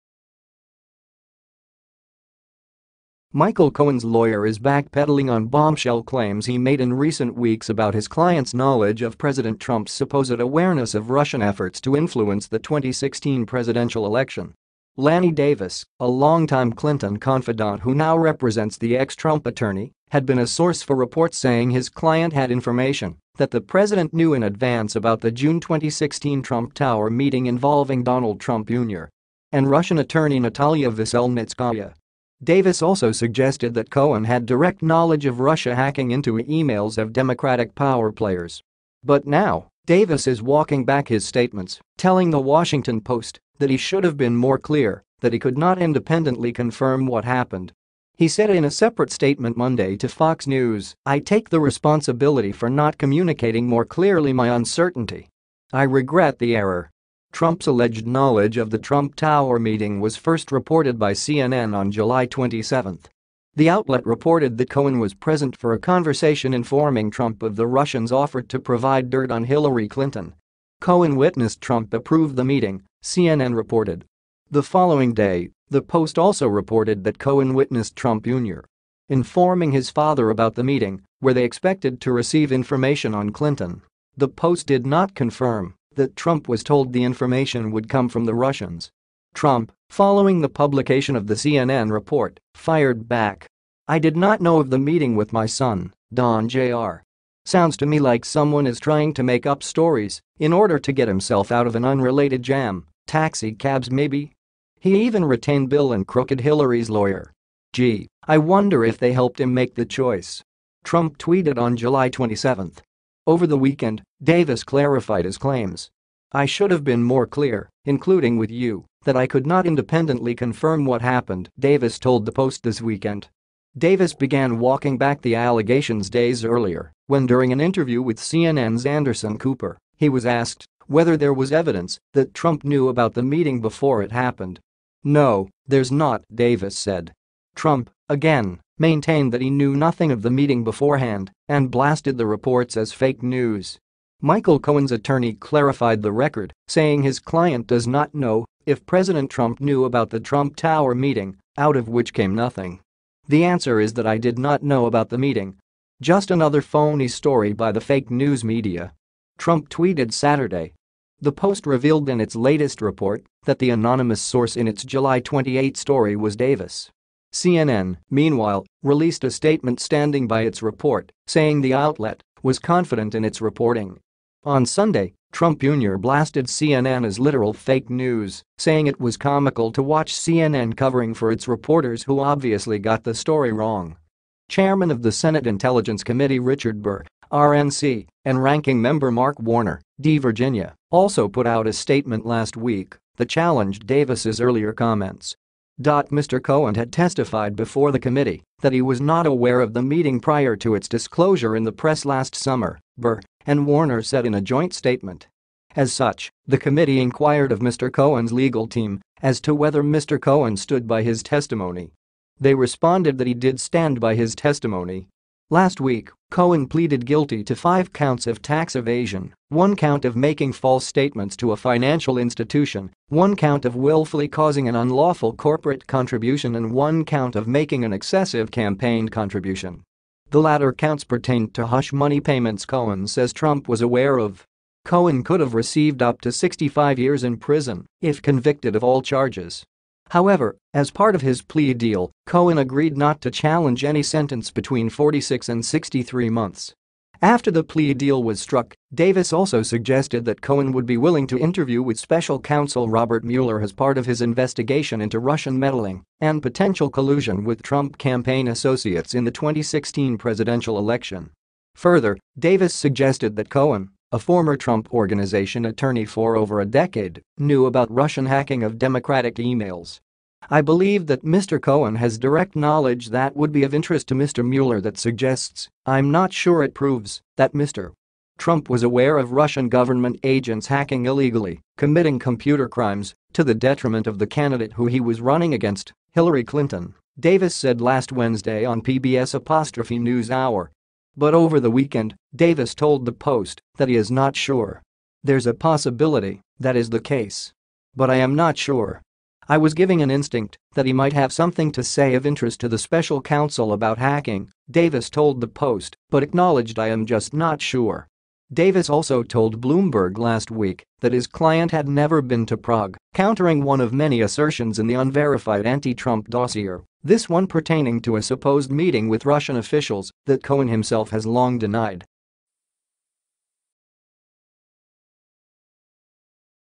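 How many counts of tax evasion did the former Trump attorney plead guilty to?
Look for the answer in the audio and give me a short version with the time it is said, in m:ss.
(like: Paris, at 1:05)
5, at 3:37.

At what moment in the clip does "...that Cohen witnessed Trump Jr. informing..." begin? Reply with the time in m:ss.
1:17.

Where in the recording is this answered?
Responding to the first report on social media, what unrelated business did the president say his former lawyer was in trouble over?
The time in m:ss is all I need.
1:43.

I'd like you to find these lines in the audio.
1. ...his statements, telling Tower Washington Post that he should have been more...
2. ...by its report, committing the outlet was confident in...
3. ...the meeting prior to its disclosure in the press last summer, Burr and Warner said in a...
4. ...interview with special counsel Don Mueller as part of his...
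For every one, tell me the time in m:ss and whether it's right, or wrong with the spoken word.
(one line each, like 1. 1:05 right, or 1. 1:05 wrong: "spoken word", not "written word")
1. 0:41 wrong: "The", not "Tower"
2. 2:50 wrong: "saying", not "committing"
3. 3:19 right
4. 4:11 wrong: "Robert", not "Don".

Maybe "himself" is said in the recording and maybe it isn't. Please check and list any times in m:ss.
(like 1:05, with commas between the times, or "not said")
1:41, 5:20.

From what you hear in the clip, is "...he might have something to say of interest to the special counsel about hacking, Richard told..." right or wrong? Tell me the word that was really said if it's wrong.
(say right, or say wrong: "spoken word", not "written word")
wrong: "Davis", not "Richard".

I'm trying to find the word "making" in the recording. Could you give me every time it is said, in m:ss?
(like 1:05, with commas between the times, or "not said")
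3:40, 3:47.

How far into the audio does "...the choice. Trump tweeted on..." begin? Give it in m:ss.
1:49.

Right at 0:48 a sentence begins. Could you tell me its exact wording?
He said in a separate statement Monday to Fox News, I take the responsibility for not communicating more clearly my uncertainty.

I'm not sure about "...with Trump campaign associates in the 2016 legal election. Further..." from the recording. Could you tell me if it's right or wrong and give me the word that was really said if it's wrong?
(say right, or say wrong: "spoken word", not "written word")
wrong: "presidential", not "legal".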